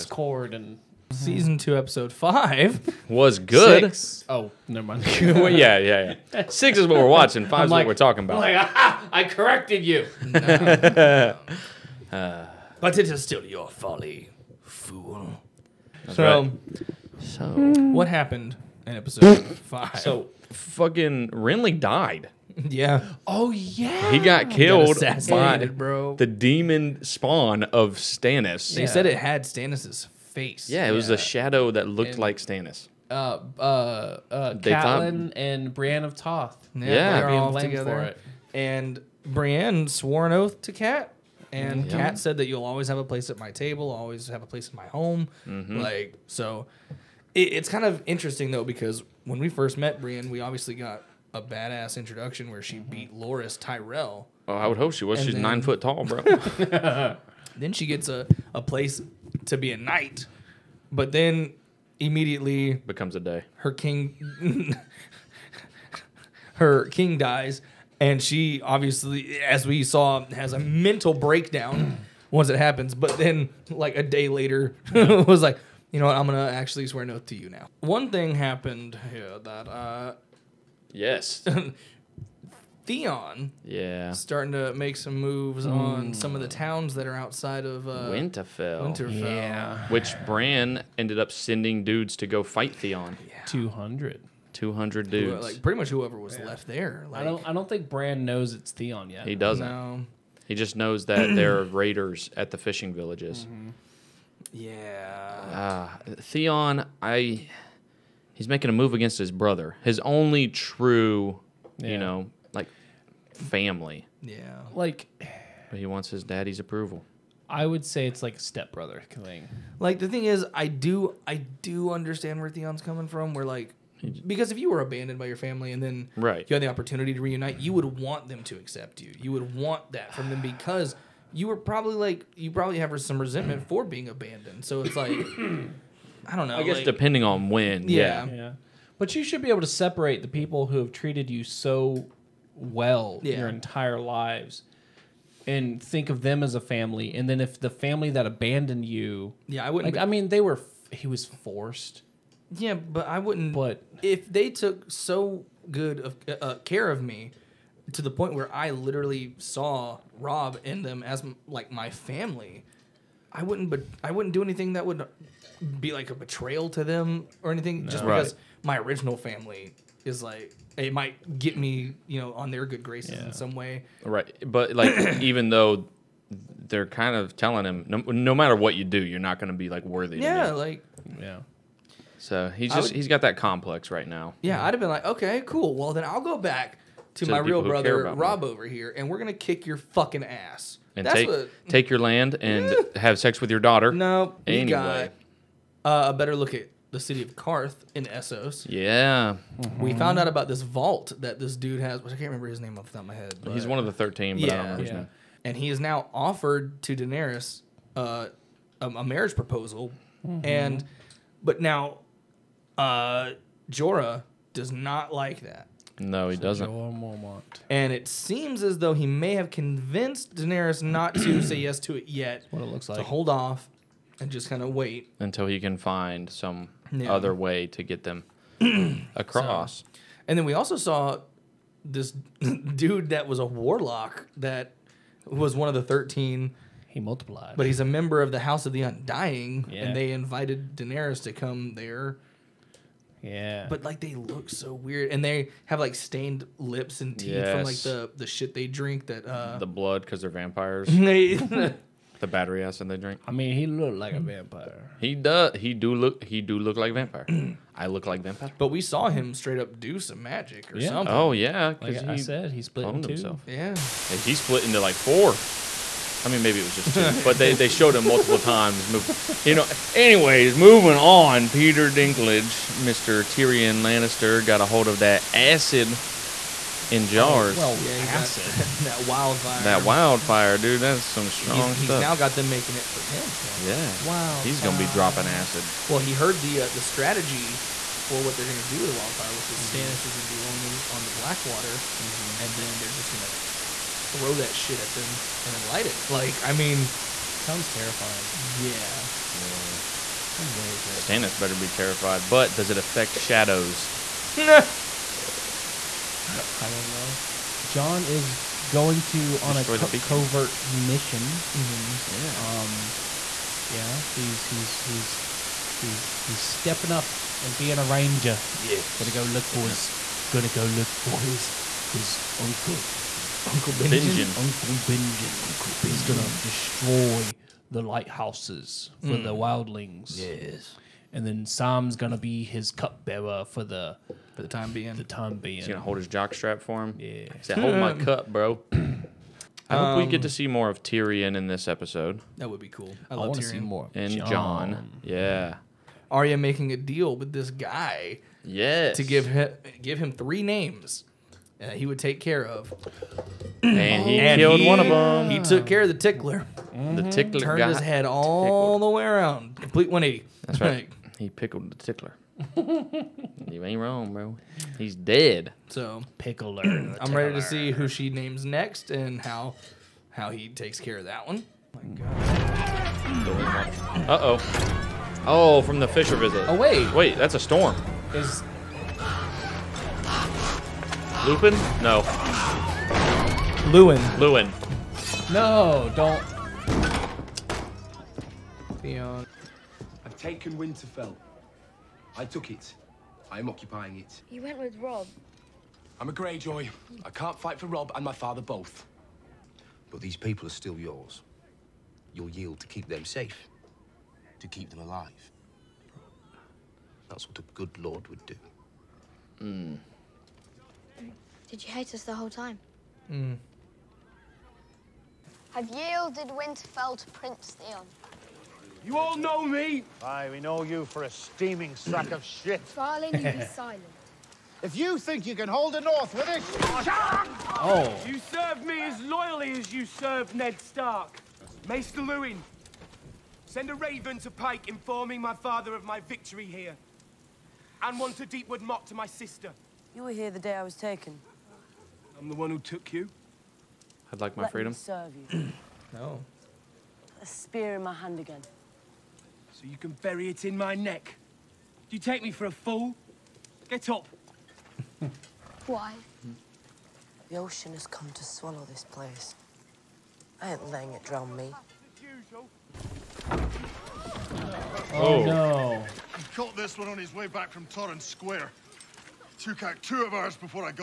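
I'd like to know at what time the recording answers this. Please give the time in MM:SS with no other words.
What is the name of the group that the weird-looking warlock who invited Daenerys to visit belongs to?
03:58.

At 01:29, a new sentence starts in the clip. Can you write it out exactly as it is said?
Which Bran ended up sending dudes to go fight Theon.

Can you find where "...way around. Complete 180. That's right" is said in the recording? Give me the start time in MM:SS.
05:58.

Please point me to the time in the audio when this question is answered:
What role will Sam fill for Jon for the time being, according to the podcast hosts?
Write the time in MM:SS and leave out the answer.
05:32.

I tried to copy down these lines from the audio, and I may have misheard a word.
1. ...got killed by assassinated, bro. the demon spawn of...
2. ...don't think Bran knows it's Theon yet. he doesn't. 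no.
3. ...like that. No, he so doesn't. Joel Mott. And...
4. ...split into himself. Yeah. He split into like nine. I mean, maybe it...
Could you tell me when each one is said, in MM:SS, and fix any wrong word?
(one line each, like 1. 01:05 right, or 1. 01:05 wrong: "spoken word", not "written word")
1. 00:24 right
2. 01:37 right
3. 03:35 wrong: "Mormont", not "Mott"
4. 04:22 wrong: "four", not "nine".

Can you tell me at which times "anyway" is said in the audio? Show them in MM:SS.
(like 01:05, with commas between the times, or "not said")
03:14, 04:29.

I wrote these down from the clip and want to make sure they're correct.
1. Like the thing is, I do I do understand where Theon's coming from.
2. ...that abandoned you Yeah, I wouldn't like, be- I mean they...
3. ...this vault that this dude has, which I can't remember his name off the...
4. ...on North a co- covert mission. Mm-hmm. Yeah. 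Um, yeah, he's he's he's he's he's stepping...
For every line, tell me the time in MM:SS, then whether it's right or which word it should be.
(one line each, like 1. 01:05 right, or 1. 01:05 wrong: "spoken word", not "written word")
1. 01:59 right
2. 02:28 right
3. 03:20 right
4. 05:09 wrong: "Destroy", not "North".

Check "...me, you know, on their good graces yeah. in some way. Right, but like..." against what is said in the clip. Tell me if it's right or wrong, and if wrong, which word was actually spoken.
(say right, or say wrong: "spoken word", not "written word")
right.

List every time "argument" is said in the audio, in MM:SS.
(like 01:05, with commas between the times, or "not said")
not said.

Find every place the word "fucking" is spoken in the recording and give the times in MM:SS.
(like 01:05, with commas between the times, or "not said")
00:20, 03:09.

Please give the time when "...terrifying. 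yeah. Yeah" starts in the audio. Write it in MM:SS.
04:57.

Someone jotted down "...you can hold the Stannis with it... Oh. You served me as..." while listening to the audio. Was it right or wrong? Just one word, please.
wrong.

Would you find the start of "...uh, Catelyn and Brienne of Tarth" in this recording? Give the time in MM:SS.
00:34.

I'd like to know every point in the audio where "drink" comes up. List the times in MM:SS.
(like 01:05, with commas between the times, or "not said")
04:08, 04:12.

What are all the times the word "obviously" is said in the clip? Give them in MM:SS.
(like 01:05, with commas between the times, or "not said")
00:50, 01:08.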